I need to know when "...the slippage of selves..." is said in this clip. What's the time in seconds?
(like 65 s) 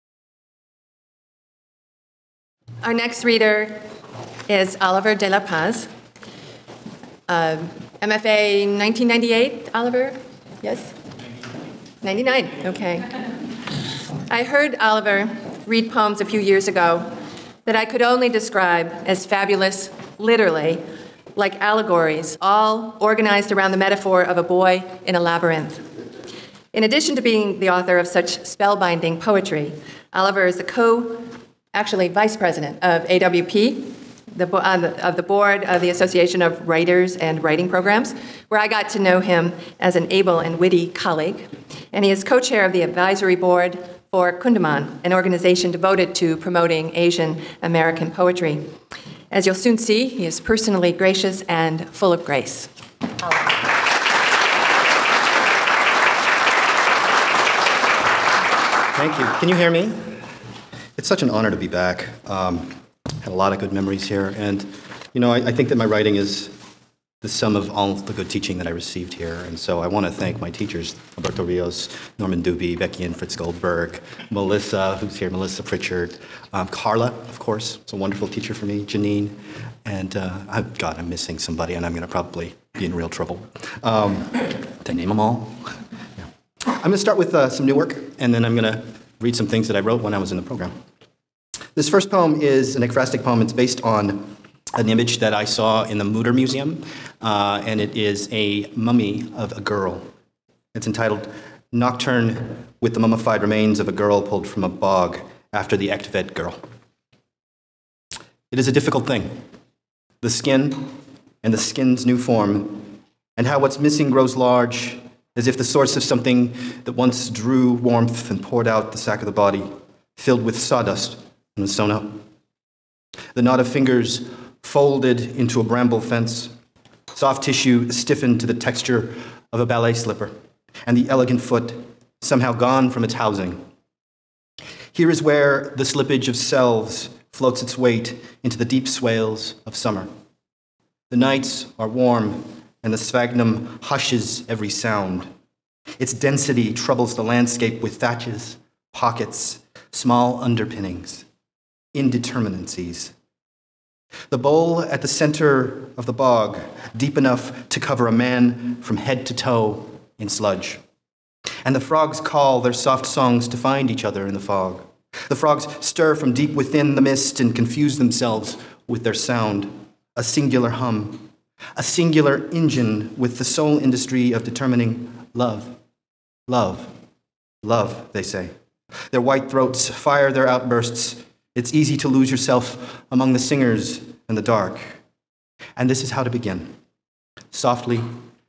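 135 s.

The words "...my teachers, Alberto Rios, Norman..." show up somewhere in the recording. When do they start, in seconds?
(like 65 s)
70 s.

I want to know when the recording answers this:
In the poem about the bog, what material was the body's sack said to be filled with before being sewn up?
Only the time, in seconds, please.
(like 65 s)
120 s.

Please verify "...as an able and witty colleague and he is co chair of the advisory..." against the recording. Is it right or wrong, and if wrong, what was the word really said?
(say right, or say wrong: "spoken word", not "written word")
right.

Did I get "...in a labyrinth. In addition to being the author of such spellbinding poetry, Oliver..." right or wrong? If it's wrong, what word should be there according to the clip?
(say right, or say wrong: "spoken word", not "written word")
right.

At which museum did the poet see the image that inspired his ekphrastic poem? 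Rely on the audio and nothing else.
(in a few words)
Mutter Museum.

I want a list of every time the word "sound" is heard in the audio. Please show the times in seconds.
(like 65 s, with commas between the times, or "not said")
144 s, 169 s.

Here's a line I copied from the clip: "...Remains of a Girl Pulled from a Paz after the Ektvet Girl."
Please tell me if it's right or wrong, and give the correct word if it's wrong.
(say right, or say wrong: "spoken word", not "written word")
wrong: "Bog", not "Paz".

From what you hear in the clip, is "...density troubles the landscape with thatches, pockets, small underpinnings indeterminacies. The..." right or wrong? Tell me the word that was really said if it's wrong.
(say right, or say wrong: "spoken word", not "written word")
right.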